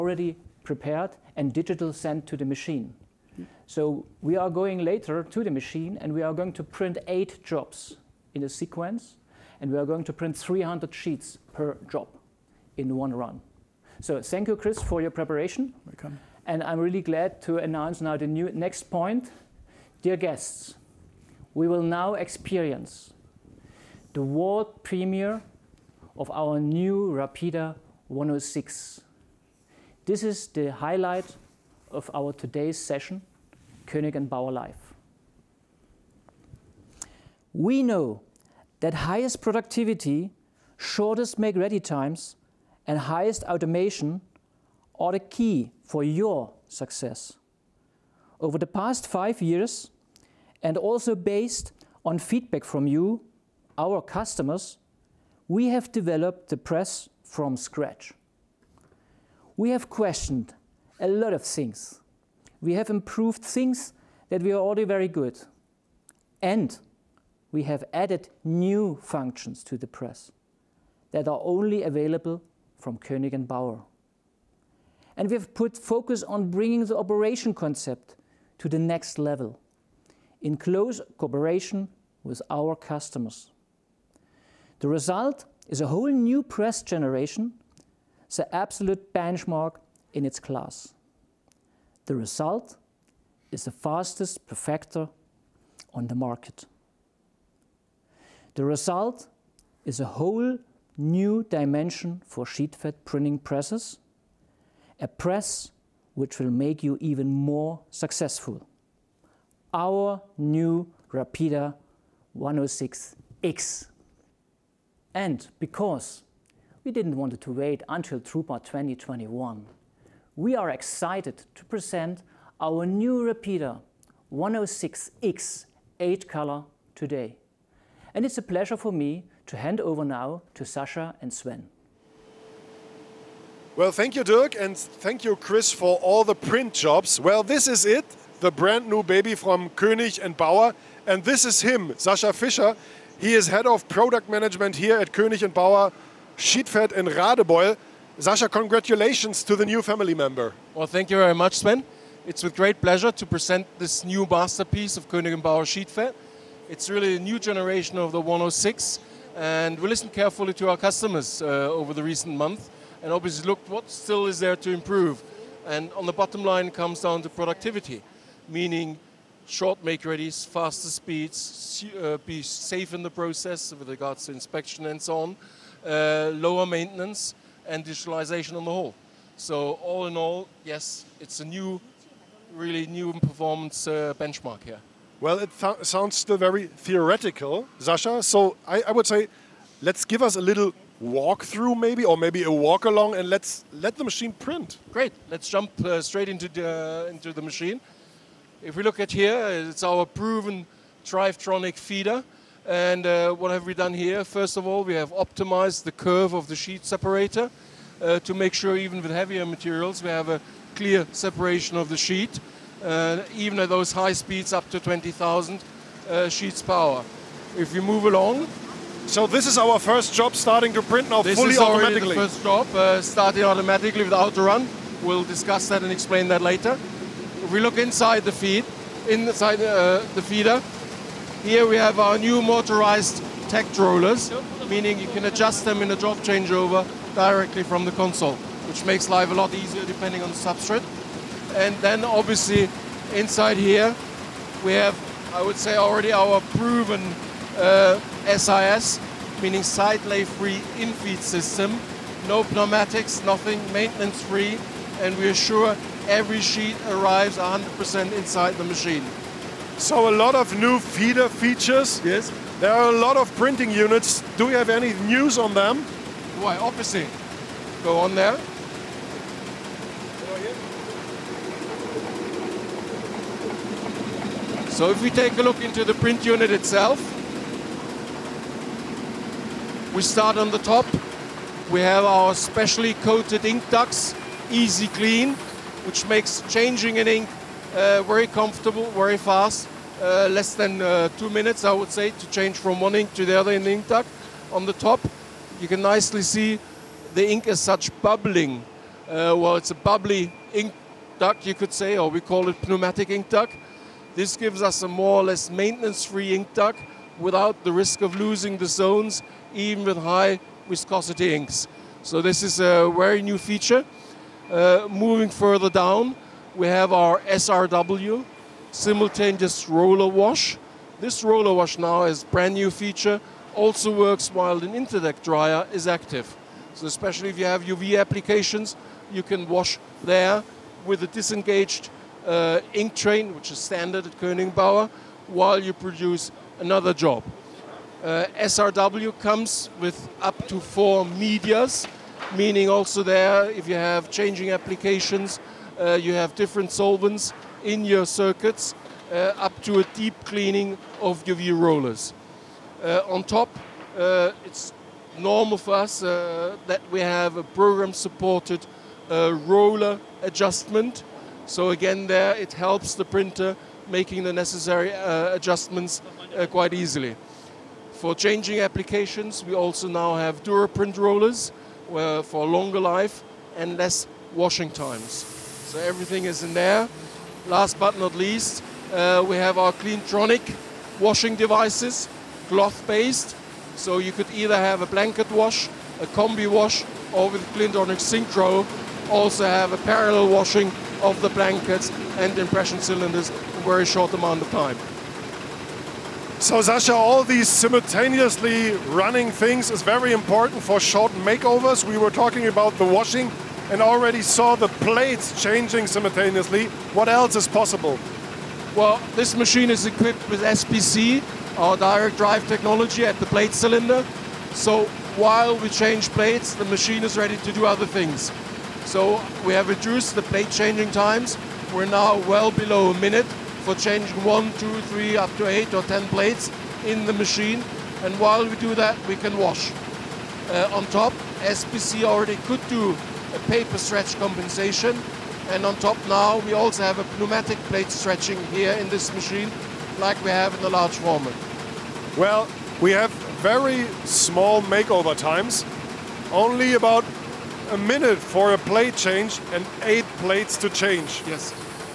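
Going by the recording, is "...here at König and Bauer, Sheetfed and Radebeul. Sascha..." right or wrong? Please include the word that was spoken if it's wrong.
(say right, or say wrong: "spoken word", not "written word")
right.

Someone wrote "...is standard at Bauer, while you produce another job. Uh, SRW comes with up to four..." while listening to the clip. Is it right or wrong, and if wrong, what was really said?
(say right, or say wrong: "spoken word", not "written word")
right.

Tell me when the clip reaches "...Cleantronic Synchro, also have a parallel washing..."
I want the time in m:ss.
6:27.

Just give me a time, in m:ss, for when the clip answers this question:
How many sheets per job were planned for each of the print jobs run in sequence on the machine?
0:10.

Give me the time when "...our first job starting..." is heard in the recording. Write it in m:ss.
3:39.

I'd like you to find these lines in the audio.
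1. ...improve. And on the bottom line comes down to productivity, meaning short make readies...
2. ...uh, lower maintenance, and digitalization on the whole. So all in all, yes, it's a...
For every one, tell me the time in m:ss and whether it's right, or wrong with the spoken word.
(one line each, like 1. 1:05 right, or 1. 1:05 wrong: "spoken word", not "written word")
1. 2:44 right
2. 2:55 right.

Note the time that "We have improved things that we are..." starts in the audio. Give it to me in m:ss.
1:02.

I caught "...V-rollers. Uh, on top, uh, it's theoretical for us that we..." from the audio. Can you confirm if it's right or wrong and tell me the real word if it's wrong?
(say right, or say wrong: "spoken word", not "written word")
wrong: "normal", not "theoretical".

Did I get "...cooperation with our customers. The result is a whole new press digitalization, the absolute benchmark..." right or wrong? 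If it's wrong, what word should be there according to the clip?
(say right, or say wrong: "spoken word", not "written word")
wrong: "generation", not "digitalization".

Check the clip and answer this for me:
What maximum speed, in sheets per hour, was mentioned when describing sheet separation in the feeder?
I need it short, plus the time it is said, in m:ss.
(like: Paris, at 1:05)
20,000, at 3:34.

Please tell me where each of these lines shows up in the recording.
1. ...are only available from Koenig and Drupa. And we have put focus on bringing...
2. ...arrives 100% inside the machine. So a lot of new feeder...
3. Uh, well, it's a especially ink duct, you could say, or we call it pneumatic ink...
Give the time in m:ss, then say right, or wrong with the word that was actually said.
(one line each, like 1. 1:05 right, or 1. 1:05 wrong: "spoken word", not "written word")
1. 1:11 wrong: "Bauer", not "Drupa"
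2. 4:16 right
3. 4:59 wrong: "bubbly", not "especially".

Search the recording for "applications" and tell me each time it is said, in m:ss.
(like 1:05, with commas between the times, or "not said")
5:27, 5:44, 6:08.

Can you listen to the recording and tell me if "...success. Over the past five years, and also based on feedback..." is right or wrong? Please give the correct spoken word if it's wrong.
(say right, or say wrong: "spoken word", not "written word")
right.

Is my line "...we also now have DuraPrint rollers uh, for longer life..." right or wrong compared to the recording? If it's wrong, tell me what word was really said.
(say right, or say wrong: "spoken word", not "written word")
right.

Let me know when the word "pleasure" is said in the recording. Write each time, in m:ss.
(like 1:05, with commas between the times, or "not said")
2:08, 2:32.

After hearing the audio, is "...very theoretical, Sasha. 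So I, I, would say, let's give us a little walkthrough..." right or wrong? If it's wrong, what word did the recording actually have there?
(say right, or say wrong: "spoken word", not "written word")
right.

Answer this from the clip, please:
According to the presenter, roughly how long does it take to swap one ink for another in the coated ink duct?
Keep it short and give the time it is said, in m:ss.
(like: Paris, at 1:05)
Less than 2 minutes, at 4:51.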